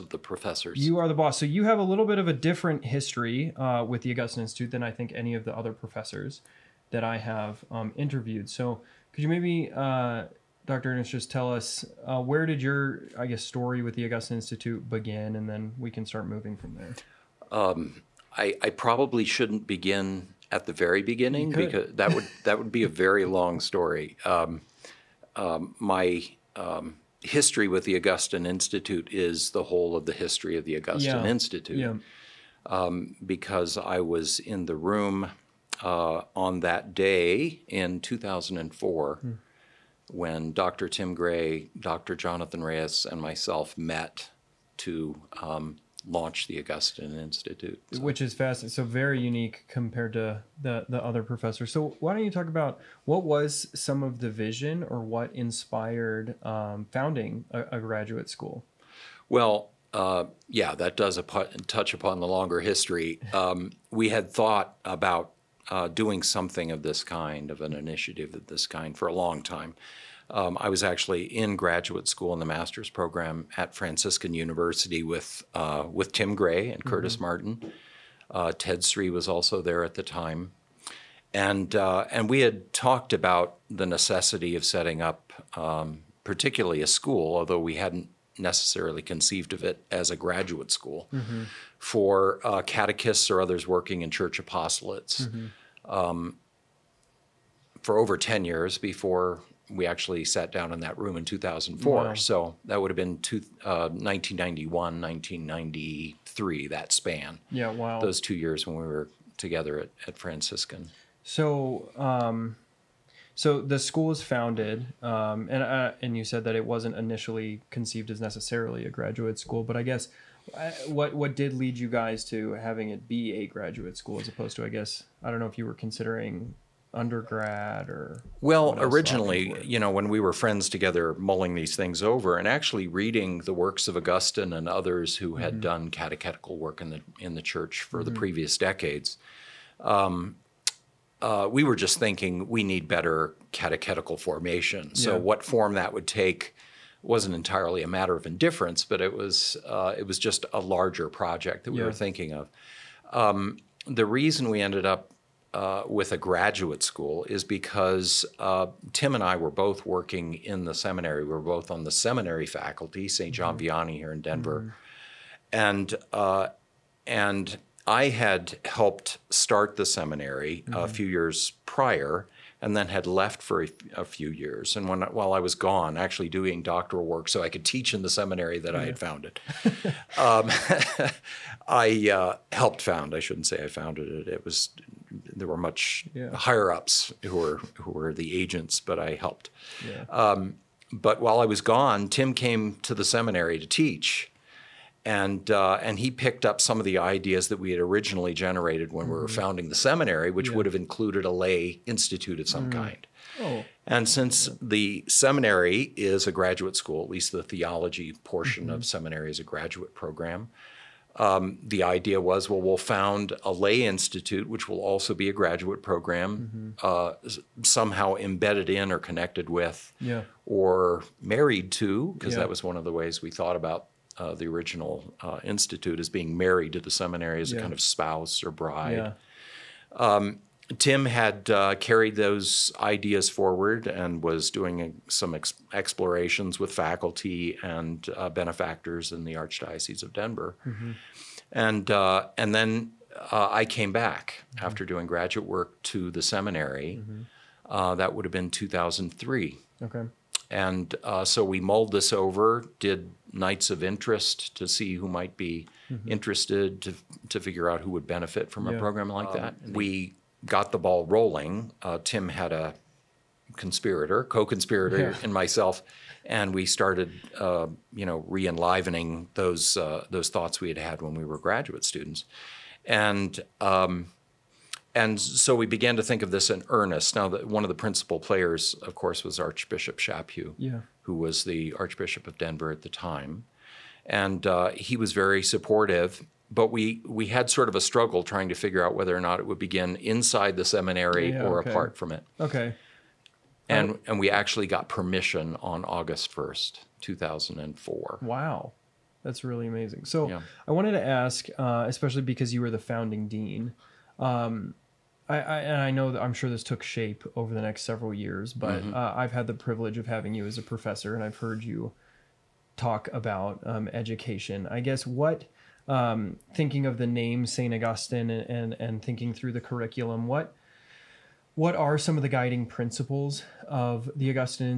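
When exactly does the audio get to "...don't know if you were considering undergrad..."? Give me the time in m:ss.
2:05.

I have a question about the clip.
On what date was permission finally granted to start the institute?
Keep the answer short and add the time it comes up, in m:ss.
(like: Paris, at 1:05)
August 1, 2004, at 4:55.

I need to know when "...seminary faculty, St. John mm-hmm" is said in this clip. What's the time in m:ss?
2:41.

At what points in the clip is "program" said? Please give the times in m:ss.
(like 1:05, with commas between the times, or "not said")
1:12, 3:29, 3:35, 4:18.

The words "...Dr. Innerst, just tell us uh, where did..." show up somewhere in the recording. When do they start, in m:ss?
0:10.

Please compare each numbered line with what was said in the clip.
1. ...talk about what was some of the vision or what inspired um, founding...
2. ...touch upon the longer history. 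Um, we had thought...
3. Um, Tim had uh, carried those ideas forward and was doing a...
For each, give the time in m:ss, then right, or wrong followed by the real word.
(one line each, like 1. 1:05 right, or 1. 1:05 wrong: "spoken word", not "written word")
1. 0:52 right
2. 1:01 right
3. 3:49 right.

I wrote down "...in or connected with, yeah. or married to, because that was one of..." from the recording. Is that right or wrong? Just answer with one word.
right.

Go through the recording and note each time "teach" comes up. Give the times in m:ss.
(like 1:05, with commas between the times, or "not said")
2:57, 3:13.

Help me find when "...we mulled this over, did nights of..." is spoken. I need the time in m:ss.
4:11.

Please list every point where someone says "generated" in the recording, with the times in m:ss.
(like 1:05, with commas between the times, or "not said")
3:18.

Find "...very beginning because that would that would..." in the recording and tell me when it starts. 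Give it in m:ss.
0:20.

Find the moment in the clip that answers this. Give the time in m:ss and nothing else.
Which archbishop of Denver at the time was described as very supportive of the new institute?
4:39.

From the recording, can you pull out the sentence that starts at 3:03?
I shouldn't say I founded it.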